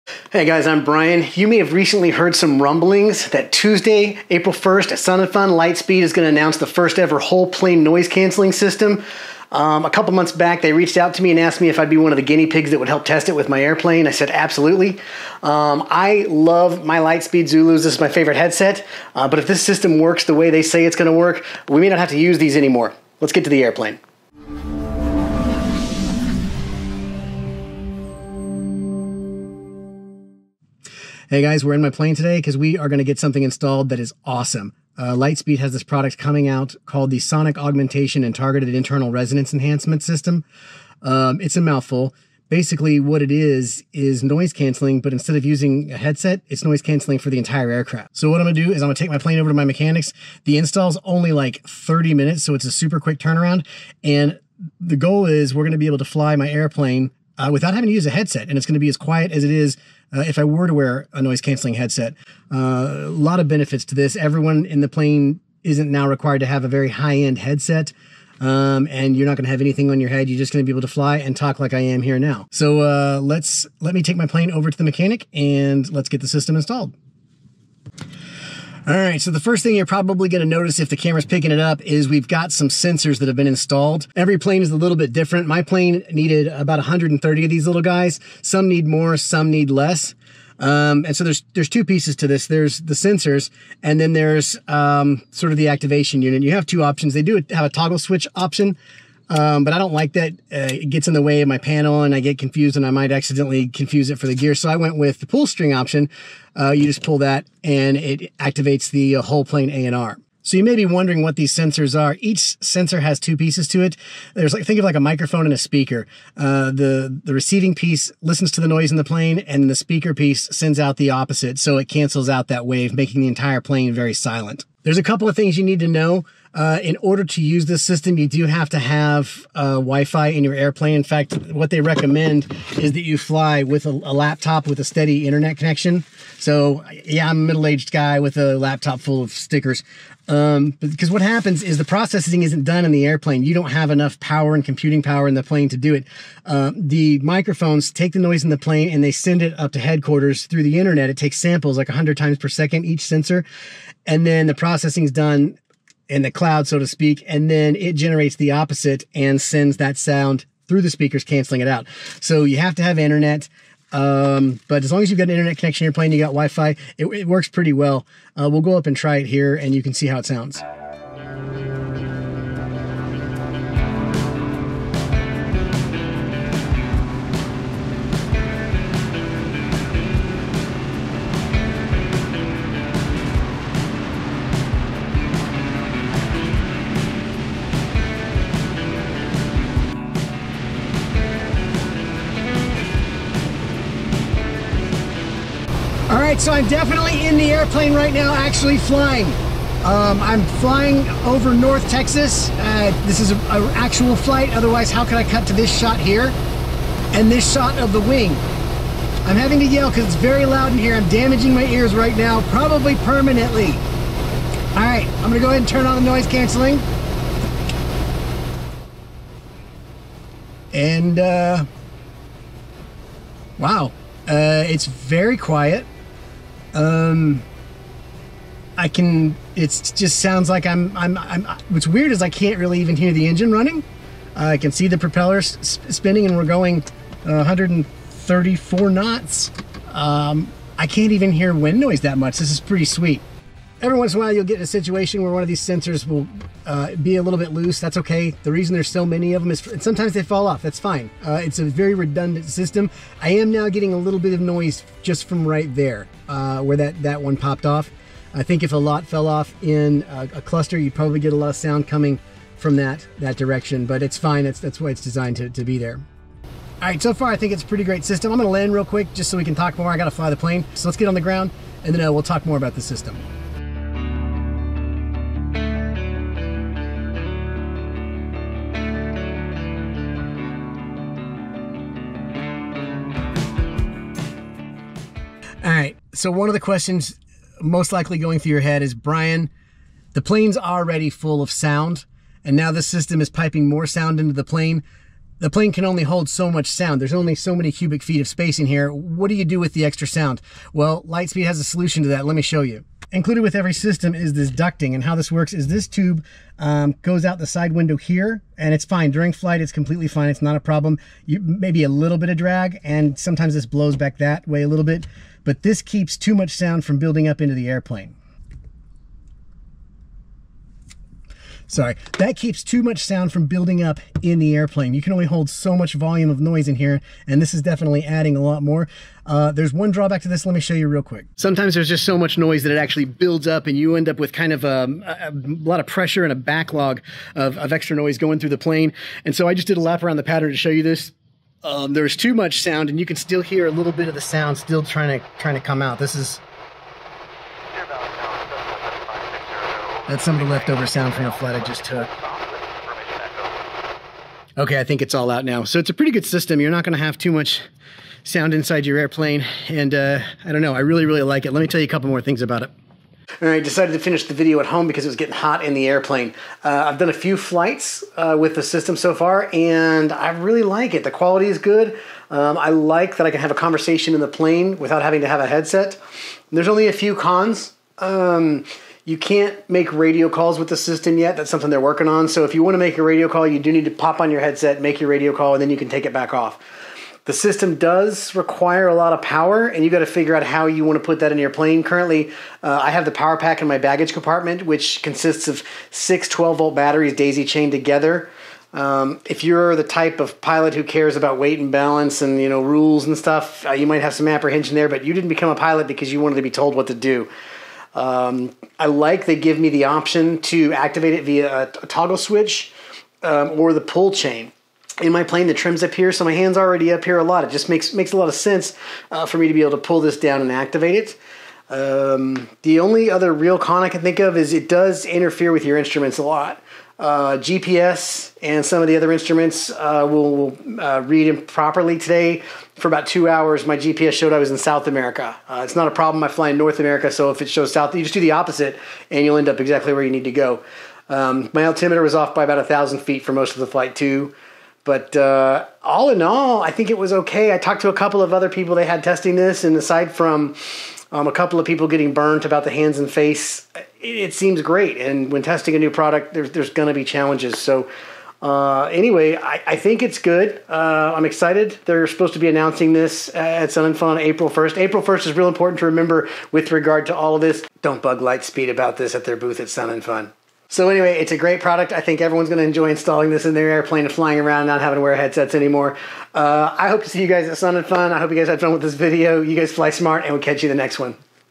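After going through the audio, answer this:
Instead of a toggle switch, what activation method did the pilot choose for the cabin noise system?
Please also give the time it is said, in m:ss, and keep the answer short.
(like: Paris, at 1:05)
pull string, at 1:45.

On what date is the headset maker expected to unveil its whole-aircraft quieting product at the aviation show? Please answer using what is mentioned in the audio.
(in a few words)
April 1st.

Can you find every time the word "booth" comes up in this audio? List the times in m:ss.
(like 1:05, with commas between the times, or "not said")
7:49.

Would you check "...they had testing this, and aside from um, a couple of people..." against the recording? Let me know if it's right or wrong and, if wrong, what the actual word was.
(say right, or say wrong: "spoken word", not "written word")
right.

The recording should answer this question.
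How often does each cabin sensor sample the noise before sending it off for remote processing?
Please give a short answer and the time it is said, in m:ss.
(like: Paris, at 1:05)
100 times per second, at 2:31.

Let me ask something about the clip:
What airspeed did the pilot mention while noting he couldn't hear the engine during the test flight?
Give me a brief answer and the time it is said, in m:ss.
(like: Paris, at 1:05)
134 knots, at 3:57.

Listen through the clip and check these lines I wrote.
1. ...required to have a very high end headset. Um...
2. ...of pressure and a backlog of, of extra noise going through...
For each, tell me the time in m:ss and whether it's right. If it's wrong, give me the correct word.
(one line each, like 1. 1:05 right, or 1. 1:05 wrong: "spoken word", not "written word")
1. 1:06 right
2. 5:35 right.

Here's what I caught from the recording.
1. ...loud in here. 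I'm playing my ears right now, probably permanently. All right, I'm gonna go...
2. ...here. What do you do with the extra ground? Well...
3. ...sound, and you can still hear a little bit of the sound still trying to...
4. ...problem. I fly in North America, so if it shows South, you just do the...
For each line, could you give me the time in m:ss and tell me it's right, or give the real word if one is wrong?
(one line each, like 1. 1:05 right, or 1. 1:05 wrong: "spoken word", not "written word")
1. 3:30 wrong: "damaging", not "playing"
2. 4:58 wrong: "sound", not "ground"
3. 5:42 right
4. 7:15 right.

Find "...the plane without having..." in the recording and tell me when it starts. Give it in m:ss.
6:14.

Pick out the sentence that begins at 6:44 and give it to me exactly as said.
But you didn't become a pilot because you wanted to be told what to do.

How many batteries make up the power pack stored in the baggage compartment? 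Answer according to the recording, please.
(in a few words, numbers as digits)
6.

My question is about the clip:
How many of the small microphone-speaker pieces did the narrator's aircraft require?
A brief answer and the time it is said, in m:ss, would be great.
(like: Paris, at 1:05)
130, at 1:26.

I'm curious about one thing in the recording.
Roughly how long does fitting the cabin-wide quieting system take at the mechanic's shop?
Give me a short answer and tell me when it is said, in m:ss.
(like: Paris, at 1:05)
30 minutes, at 0:51.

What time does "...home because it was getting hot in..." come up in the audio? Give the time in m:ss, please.
6:04.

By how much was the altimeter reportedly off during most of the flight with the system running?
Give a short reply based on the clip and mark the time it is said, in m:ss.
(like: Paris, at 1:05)
1000 feet, at 7:22.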